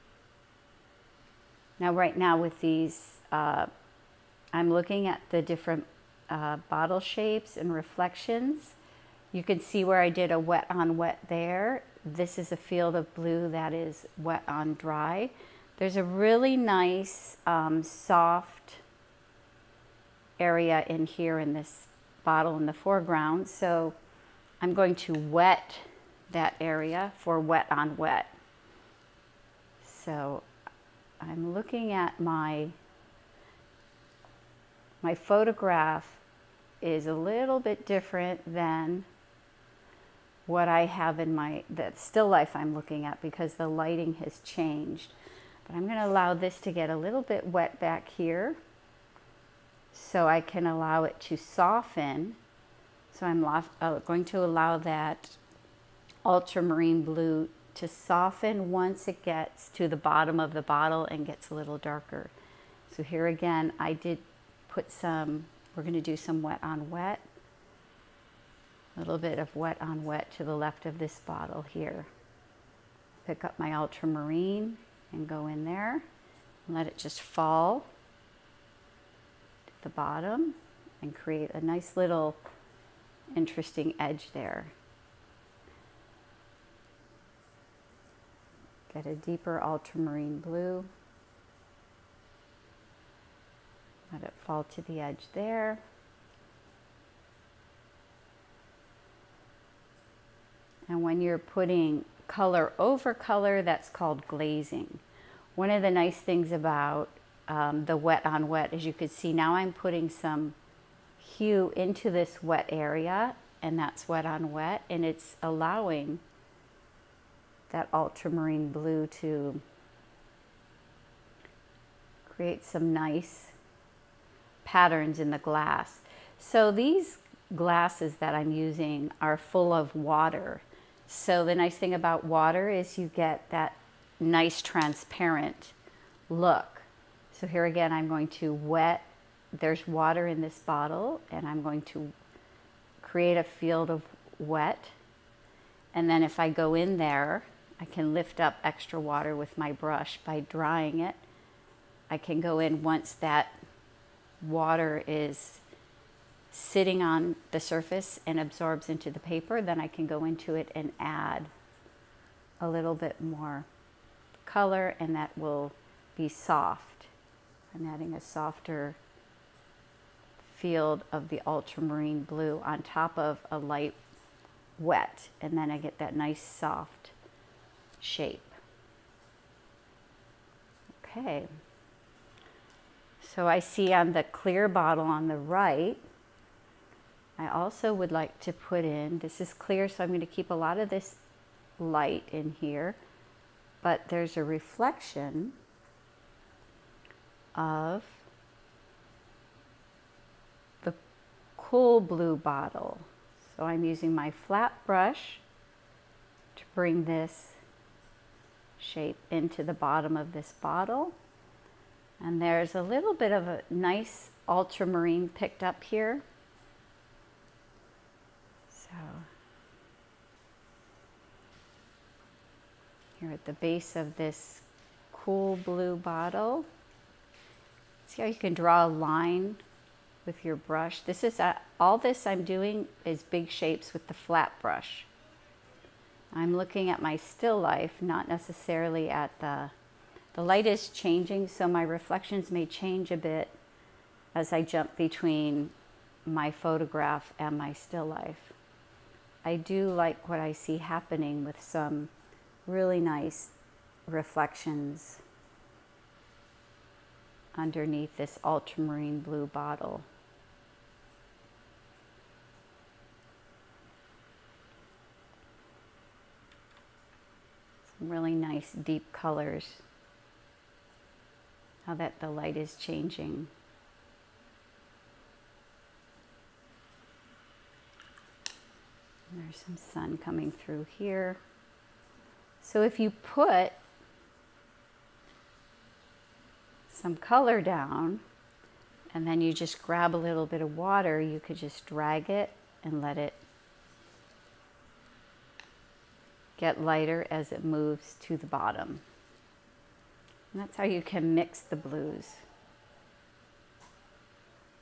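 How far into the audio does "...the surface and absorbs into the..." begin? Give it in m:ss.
2:37.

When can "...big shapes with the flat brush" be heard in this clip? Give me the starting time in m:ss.
3:53.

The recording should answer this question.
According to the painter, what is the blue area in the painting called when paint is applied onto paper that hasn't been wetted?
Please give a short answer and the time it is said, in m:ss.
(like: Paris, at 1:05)
Wet on dry, at 0:14.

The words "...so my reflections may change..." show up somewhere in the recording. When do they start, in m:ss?
4:01.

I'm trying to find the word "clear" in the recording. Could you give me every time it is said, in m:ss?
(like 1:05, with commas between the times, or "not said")
3:04, 3:09.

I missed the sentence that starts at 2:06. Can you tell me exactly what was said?
So these glasses that I'm using are full of water.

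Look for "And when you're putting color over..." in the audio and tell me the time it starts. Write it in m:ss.
1:40.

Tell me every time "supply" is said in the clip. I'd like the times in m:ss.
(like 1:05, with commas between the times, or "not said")
not said.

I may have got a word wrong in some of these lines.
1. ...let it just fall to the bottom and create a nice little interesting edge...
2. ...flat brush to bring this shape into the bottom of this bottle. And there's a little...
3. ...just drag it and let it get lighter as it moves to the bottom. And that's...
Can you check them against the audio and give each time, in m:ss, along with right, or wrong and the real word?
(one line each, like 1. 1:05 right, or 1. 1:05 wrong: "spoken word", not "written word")
1. 1:16 right
2. 3:24 right
3. 4:51 right.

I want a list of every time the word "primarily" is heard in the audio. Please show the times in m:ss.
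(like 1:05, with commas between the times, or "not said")
not said.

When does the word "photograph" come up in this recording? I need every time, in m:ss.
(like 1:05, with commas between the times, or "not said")
0:35, 4:06.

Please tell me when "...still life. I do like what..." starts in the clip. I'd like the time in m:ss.
4:07.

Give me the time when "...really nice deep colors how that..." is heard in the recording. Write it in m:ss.
4:28.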